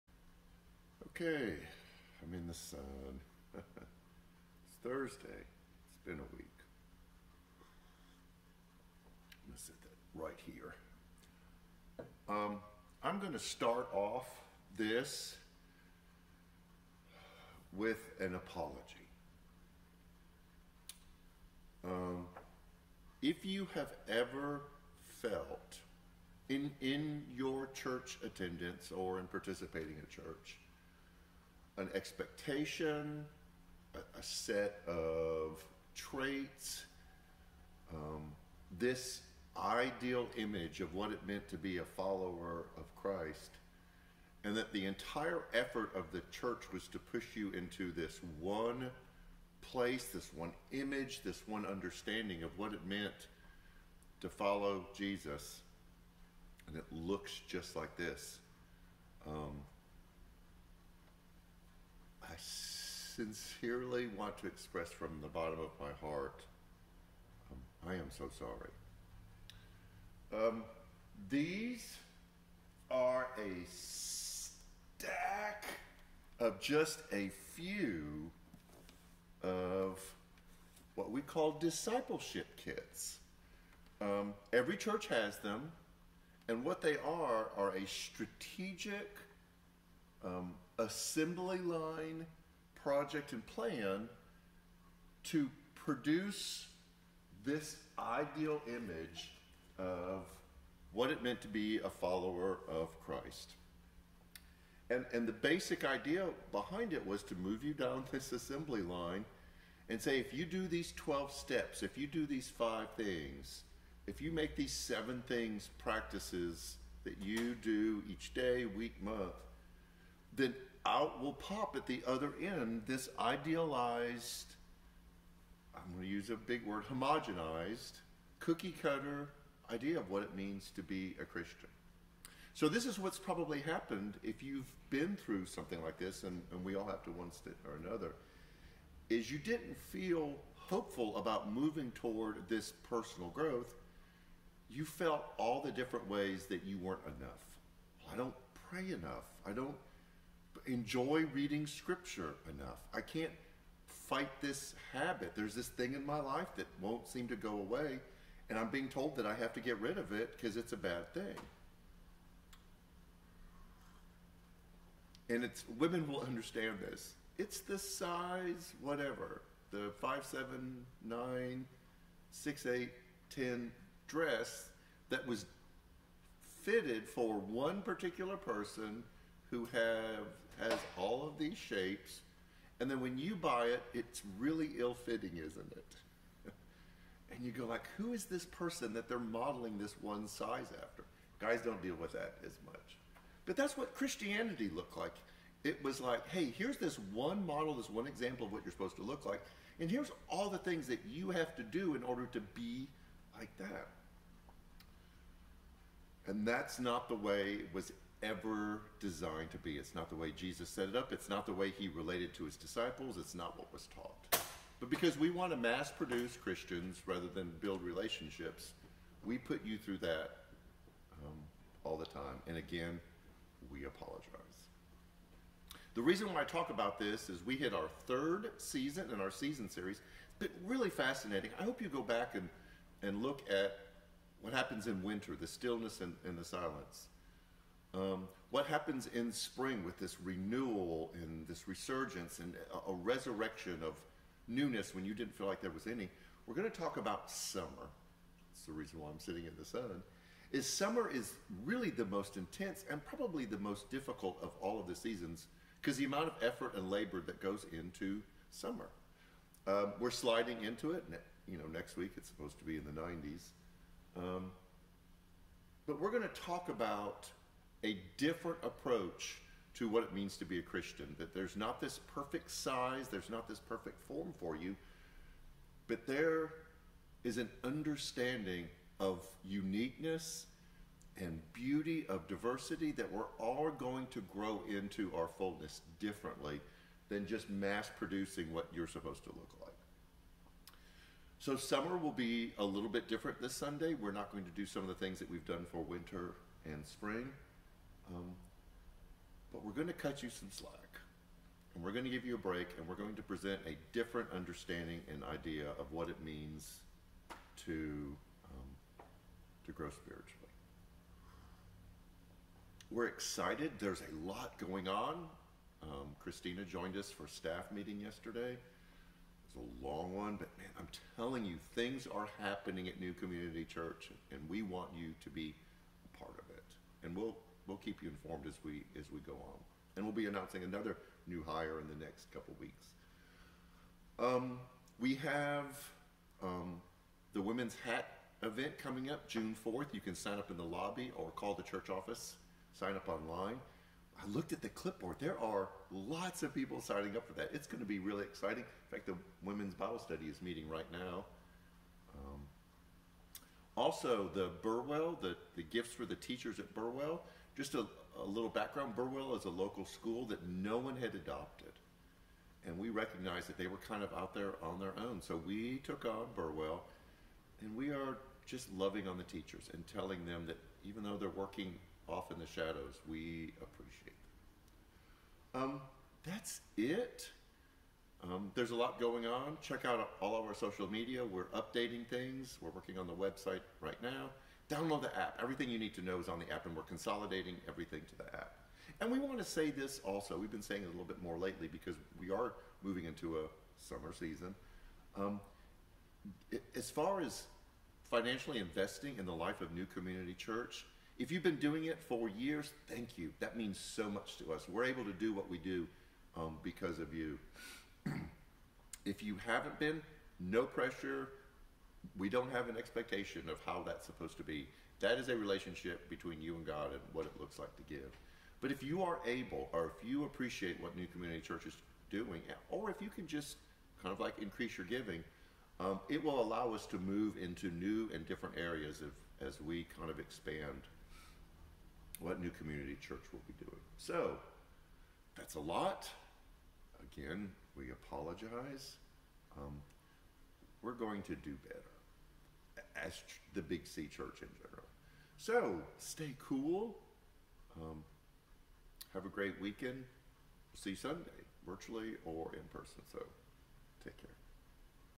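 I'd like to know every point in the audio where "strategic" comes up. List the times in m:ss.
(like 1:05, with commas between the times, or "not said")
1:27.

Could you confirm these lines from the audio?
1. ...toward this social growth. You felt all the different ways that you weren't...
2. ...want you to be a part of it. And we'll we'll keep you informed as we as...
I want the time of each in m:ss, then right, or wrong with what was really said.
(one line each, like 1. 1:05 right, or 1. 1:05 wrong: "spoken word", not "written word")
1. 2:21 wrong: "personal", not "social"
2. 5:24 right.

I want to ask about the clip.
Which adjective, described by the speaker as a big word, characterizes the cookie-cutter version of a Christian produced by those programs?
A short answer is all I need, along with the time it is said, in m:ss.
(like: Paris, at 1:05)
Homogenized, at 2:06.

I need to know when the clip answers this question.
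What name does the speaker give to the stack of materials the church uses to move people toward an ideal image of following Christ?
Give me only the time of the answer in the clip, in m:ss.
1:21.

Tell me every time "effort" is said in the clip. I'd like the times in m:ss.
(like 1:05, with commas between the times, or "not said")
0:45, 4:16.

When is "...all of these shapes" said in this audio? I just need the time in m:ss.
3:00.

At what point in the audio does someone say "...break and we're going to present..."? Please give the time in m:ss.
5:02.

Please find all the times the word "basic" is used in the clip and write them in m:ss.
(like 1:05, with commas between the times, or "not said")
1:45.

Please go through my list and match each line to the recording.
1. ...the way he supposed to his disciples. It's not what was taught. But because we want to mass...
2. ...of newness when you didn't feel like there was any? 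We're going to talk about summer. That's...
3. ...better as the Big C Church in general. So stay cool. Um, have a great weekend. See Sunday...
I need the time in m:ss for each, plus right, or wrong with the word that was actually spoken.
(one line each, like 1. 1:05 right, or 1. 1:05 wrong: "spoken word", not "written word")
1. 3:31 wrong: "related", not "supposed"
2. 4:03 right
3. 7:21 right.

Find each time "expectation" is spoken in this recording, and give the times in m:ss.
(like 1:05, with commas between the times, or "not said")
0:31, 6:52.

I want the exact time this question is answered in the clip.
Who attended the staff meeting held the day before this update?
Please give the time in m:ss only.
5:16.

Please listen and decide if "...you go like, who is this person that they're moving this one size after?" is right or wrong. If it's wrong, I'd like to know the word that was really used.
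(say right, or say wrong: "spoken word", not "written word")
wrong: "modeling", not "moving".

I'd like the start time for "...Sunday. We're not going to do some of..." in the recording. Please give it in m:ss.
4:53.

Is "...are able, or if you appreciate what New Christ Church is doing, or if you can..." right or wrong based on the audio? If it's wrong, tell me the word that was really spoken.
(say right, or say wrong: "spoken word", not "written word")
wrong: "Community", not "Christ".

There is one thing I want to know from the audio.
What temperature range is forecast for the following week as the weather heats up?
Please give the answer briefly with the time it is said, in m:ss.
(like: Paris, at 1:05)
The 90s, at 4:22.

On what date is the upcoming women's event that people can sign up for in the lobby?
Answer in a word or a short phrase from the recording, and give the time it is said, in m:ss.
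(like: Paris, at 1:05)
June 4th, at 5:39.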